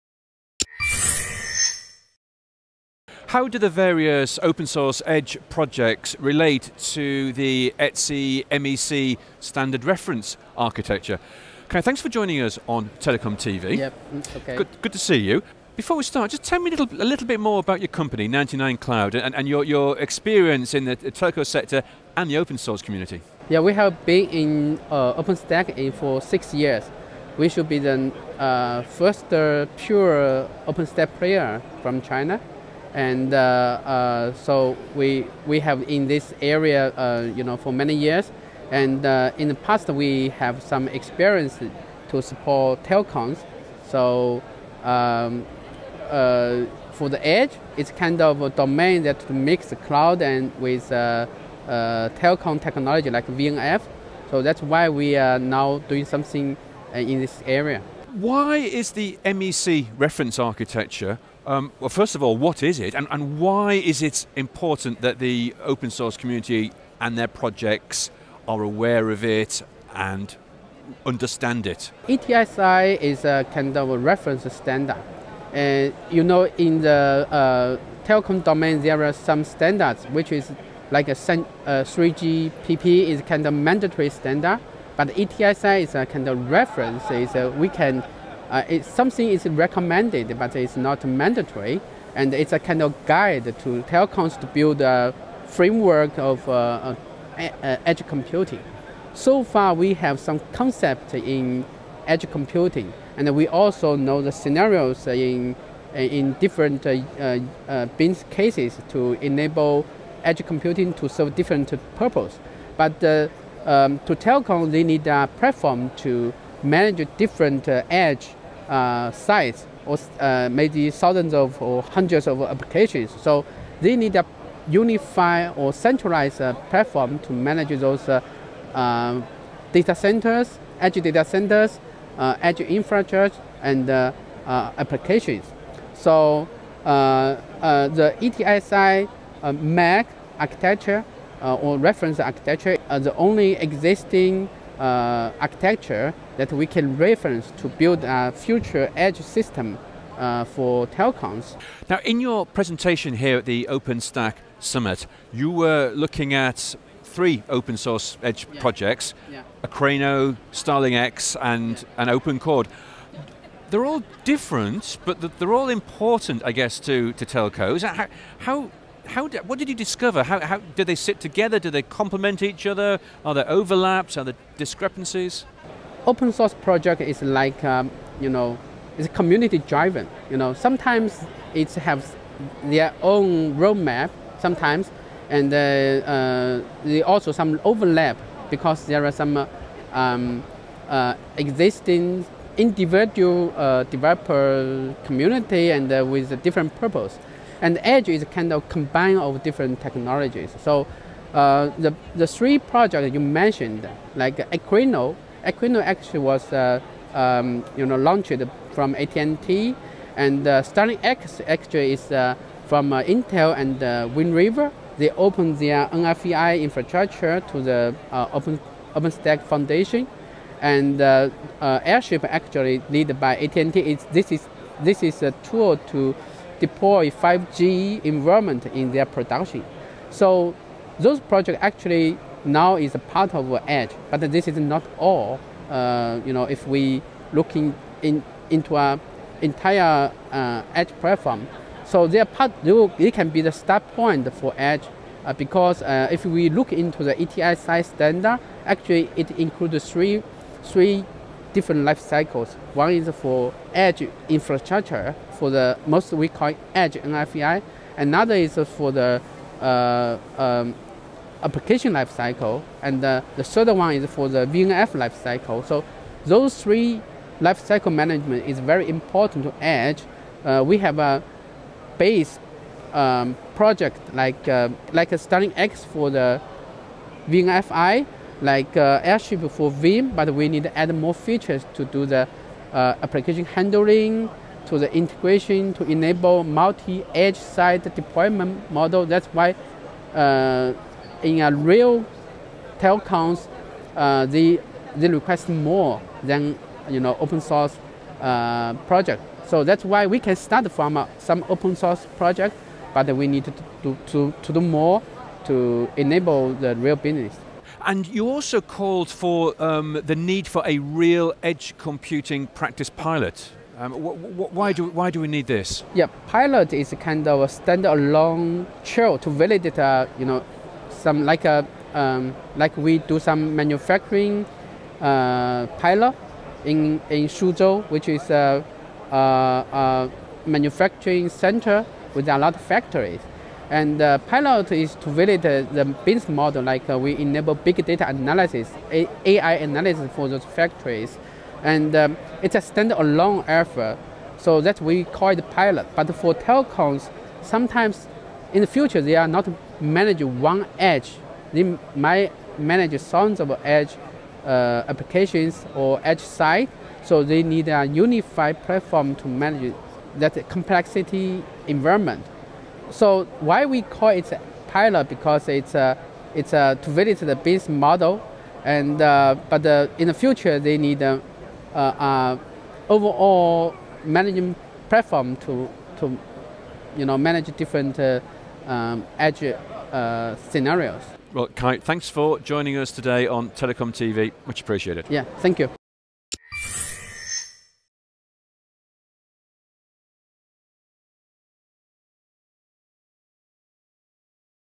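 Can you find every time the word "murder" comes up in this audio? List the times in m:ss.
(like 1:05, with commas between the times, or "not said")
not said.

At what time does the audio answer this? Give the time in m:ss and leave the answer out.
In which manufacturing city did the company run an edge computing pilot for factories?
5:27.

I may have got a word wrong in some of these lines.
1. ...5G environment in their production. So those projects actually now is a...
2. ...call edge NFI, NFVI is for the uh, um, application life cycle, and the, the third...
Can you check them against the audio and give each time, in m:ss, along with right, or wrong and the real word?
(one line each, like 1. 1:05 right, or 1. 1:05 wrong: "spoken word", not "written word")
1. 3:47 right
2. 4:16 wrong: "Another", not "NFVI".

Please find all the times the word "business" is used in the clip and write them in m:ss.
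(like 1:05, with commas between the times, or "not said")
1:47, 5:06, 5:36.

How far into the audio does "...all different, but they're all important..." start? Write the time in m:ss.
2:43.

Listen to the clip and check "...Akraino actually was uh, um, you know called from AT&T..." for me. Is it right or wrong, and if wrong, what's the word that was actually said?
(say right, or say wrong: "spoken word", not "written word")
wrong: "launched", not "called".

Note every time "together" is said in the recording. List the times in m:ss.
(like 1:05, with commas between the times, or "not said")
2:51.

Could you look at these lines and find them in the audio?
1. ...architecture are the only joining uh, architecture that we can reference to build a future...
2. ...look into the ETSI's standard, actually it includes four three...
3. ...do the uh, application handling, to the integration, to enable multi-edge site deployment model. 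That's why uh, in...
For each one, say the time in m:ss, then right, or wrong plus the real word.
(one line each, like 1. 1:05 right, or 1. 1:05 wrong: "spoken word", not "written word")
1. 2:22 wrong: "existing", not "joining"
2. 4:06 wrong: "three", not "four"
3. 4:41 right.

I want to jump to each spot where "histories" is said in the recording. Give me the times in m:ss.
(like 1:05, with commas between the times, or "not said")
not said.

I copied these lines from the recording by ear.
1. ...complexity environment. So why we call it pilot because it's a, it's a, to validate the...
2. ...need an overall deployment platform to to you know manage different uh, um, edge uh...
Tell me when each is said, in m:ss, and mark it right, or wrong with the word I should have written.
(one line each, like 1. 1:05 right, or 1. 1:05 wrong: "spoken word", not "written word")
1. 6:00 right
2. 6:10 wrong: "management", not "deployment".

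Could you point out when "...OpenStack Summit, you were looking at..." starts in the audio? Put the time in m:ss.
2:33.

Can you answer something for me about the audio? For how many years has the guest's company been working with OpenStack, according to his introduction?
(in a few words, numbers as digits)
6.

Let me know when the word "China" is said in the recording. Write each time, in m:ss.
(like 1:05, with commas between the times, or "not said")
0:32.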